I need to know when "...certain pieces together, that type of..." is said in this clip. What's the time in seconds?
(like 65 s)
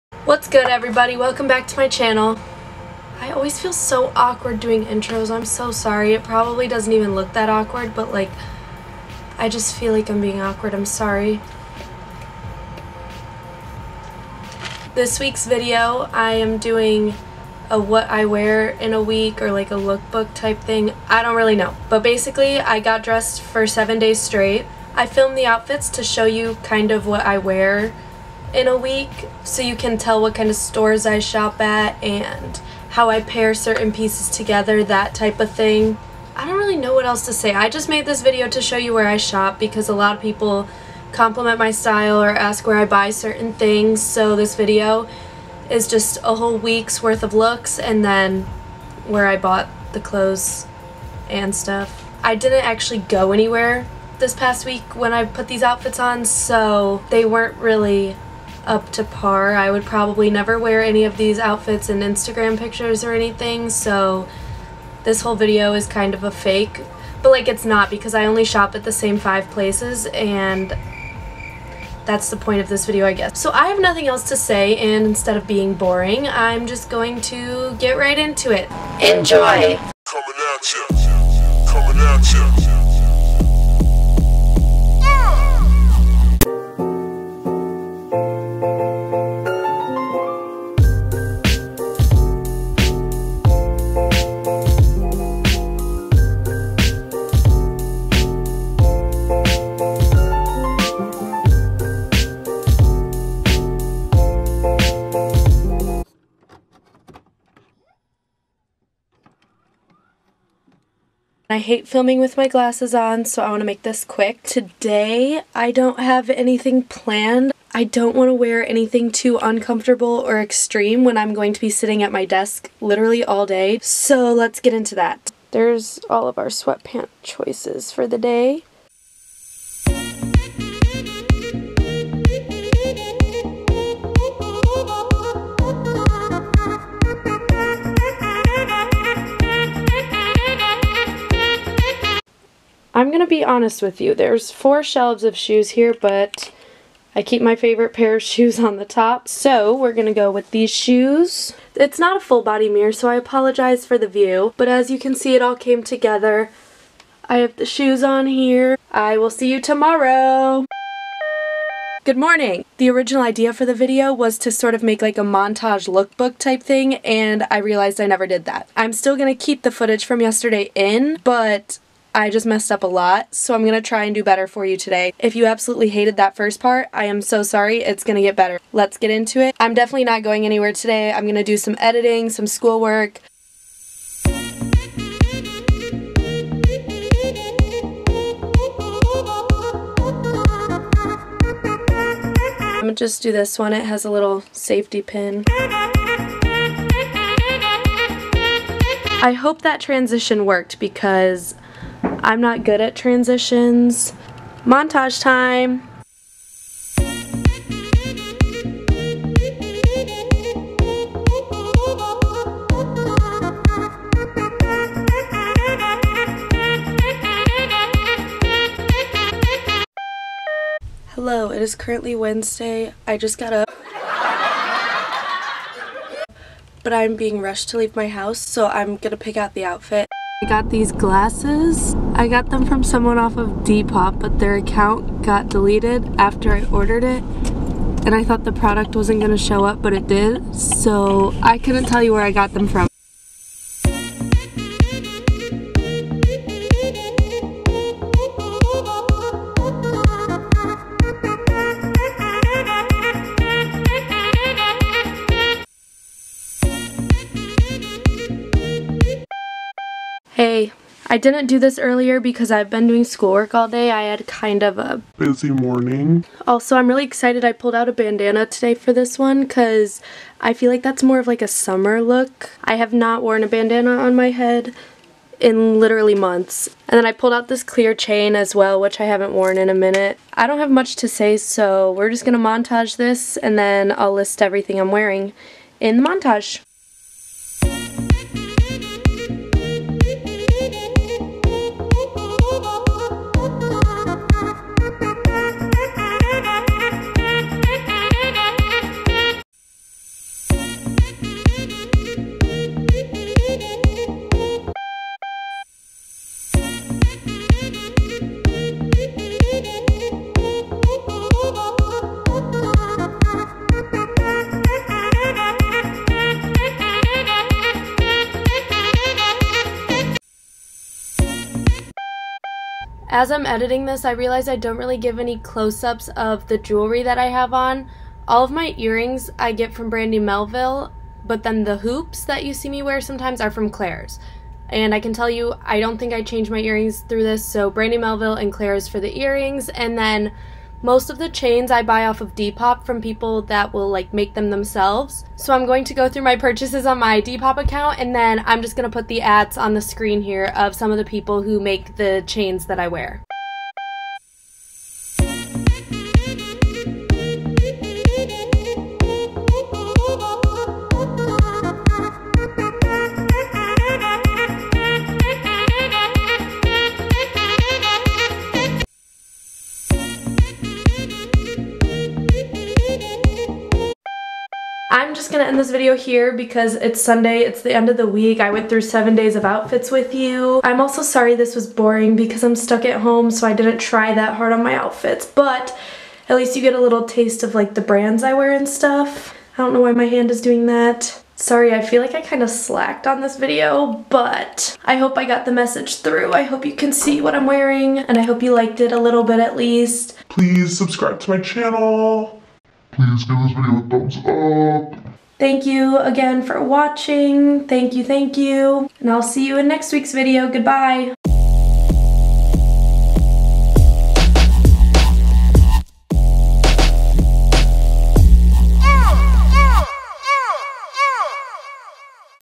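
33 s.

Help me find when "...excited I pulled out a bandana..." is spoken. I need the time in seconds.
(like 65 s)
267 s.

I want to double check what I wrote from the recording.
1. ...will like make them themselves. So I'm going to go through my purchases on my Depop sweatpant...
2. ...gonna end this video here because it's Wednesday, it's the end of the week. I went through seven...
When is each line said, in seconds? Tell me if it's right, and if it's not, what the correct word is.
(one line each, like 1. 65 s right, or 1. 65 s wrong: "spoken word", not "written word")
1. 343 s wrong: "account", not "sweatpant"
2. 375 s wrong: "Sunday", not "Wednesday".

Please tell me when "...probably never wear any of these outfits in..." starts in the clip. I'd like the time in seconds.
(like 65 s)
59 s.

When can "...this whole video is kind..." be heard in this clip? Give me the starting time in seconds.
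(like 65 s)
65 s.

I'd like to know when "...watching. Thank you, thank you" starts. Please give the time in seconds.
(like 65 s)
406 s.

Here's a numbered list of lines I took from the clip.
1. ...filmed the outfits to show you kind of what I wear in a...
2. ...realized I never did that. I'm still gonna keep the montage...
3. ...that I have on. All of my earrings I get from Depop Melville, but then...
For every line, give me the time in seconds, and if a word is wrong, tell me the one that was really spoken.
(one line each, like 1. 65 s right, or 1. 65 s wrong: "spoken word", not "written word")
1. 25 s right
2. 167 s wrong: "footage", not "montage"
3. 327 s wrong: "Brandy", not "Depop".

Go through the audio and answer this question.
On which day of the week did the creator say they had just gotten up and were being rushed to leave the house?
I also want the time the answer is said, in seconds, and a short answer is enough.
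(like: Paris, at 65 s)
Wednesday, at 222 s.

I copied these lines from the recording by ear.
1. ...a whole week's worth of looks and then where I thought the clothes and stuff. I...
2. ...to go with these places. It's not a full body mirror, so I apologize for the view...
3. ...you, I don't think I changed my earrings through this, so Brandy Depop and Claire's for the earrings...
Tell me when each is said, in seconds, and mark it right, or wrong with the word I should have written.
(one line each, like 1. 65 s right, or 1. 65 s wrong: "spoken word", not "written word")
1. 46 s wrong: "bought", not "thought"
2. 150 s wrong: "shoes", not "places"
3. 335 s wrong: "Melville", not "Depop".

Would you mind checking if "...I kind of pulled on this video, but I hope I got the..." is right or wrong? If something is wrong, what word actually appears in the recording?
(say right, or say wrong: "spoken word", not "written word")
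wrong: "slacked", not "pulled".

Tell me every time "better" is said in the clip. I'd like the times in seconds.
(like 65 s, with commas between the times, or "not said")
174 s, 178 s.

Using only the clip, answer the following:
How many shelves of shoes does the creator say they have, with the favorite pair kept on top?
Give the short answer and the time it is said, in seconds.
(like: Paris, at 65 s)
4, at 144 s.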